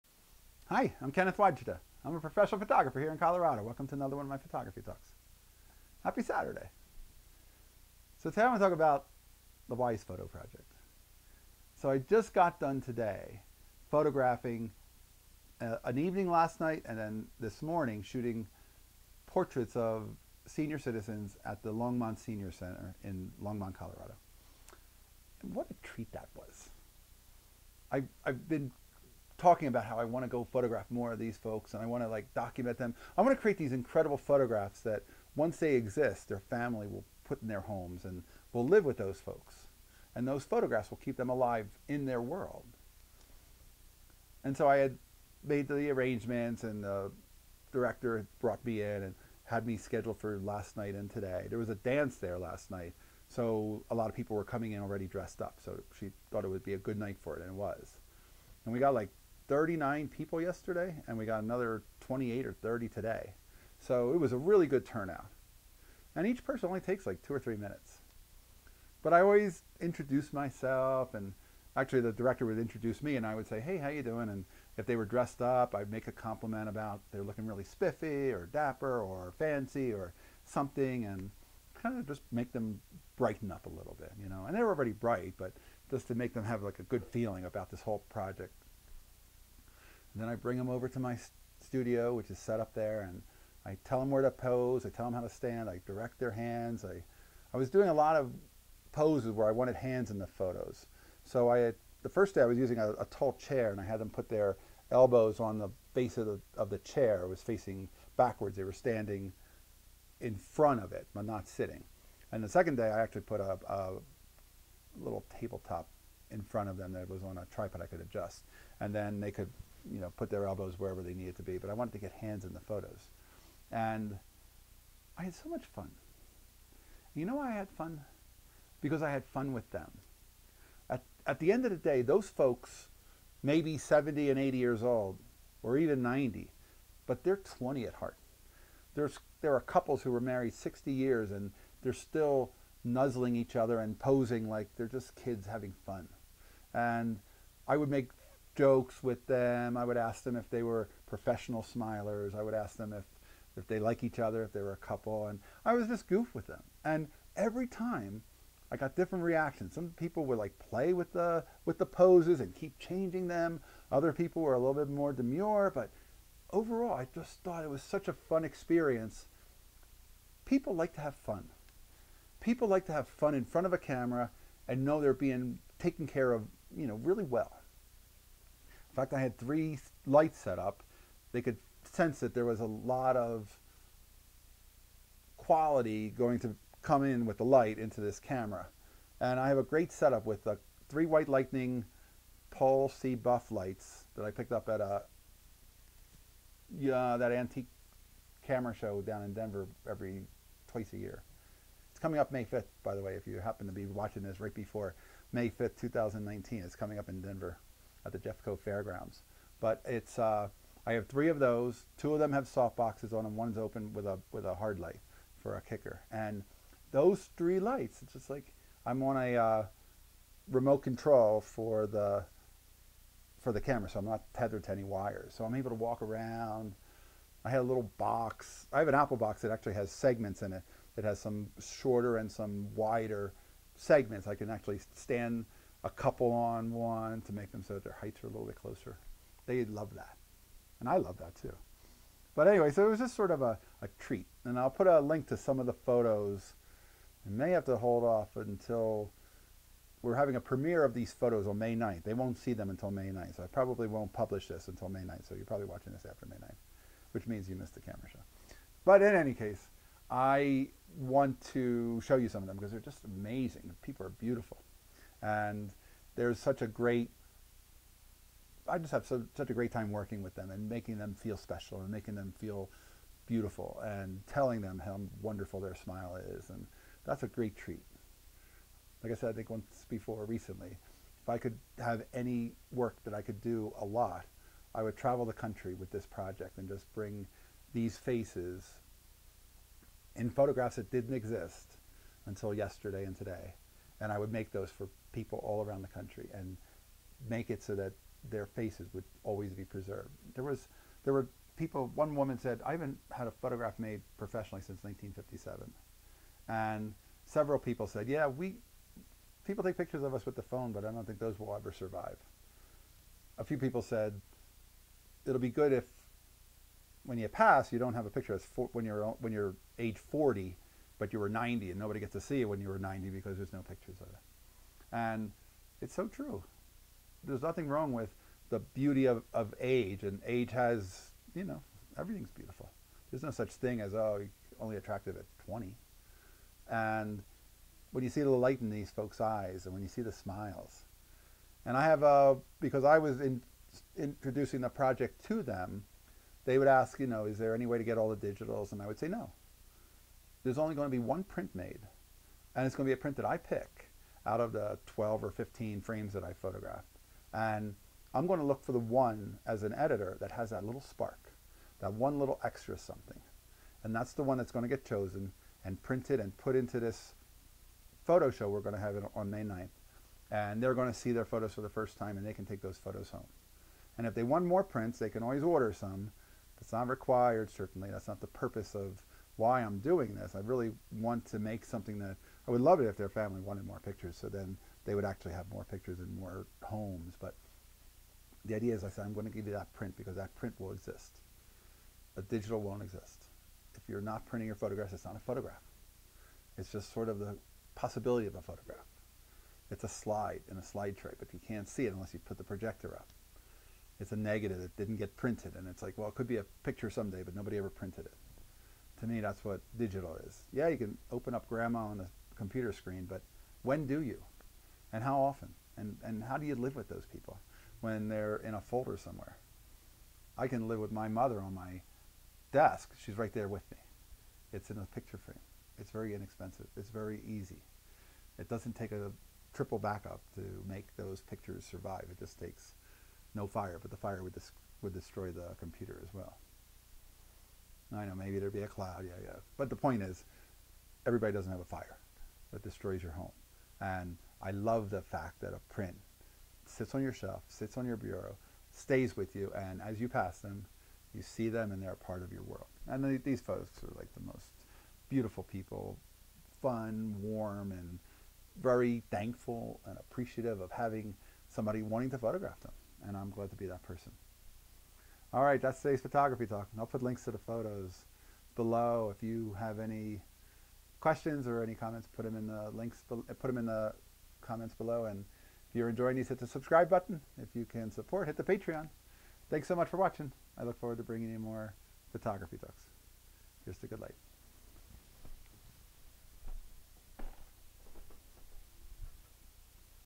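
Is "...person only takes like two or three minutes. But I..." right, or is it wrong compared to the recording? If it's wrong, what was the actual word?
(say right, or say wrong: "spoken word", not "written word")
right.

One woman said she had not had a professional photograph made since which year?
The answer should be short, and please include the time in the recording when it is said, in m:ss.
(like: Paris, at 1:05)
1957, at 5:04.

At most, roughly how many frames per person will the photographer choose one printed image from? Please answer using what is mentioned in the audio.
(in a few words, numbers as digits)
15.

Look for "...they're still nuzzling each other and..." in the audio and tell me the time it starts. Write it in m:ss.
2:21.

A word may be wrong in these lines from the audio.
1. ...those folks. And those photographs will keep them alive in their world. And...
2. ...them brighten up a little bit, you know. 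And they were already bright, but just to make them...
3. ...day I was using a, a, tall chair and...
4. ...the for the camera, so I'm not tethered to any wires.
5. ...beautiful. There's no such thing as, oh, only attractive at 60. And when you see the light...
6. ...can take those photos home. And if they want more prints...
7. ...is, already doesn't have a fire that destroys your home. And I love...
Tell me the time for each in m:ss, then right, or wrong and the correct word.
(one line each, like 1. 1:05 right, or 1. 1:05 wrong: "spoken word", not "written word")
1. 0:38 right
2. 1:22 right
3. 1:42 right
4. 3:41 right
5. 5:32 wrong: "20", not "60"
6. 6:12 right
7. 7:20 wrong: "everybody", not "already".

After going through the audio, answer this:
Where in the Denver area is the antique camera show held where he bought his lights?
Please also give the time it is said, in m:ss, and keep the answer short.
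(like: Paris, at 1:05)
Jeffco Fairgrounds, at 3:28.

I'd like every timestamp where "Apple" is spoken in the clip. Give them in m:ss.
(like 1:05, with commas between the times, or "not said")
3:48.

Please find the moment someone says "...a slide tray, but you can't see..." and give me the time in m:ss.
6:40.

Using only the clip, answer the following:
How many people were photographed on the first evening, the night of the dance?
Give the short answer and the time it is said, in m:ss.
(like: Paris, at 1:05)
39, at 0:59.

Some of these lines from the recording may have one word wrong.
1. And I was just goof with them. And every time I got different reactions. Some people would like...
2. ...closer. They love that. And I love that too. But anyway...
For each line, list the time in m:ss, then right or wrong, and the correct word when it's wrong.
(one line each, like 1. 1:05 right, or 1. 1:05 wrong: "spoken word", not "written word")
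1. 2:35 right
2. 3:58 right.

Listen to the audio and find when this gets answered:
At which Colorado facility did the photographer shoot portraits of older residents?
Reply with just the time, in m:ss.
0:21.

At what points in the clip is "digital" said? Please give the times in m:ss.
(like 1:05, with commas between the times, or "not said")
5:48, 6:32, 6:49.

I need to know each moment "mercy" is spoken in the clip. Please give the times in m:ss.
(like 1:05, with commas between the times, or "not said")
not said.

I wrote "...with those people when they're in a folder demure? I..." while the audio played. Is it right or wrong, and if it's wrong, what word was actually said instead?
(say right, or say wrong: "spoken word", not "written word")
wrong: "somewhere", not "demure".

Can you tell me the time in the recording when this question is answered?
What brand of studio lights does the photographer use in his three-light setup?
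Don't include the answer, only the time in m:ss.
3:12.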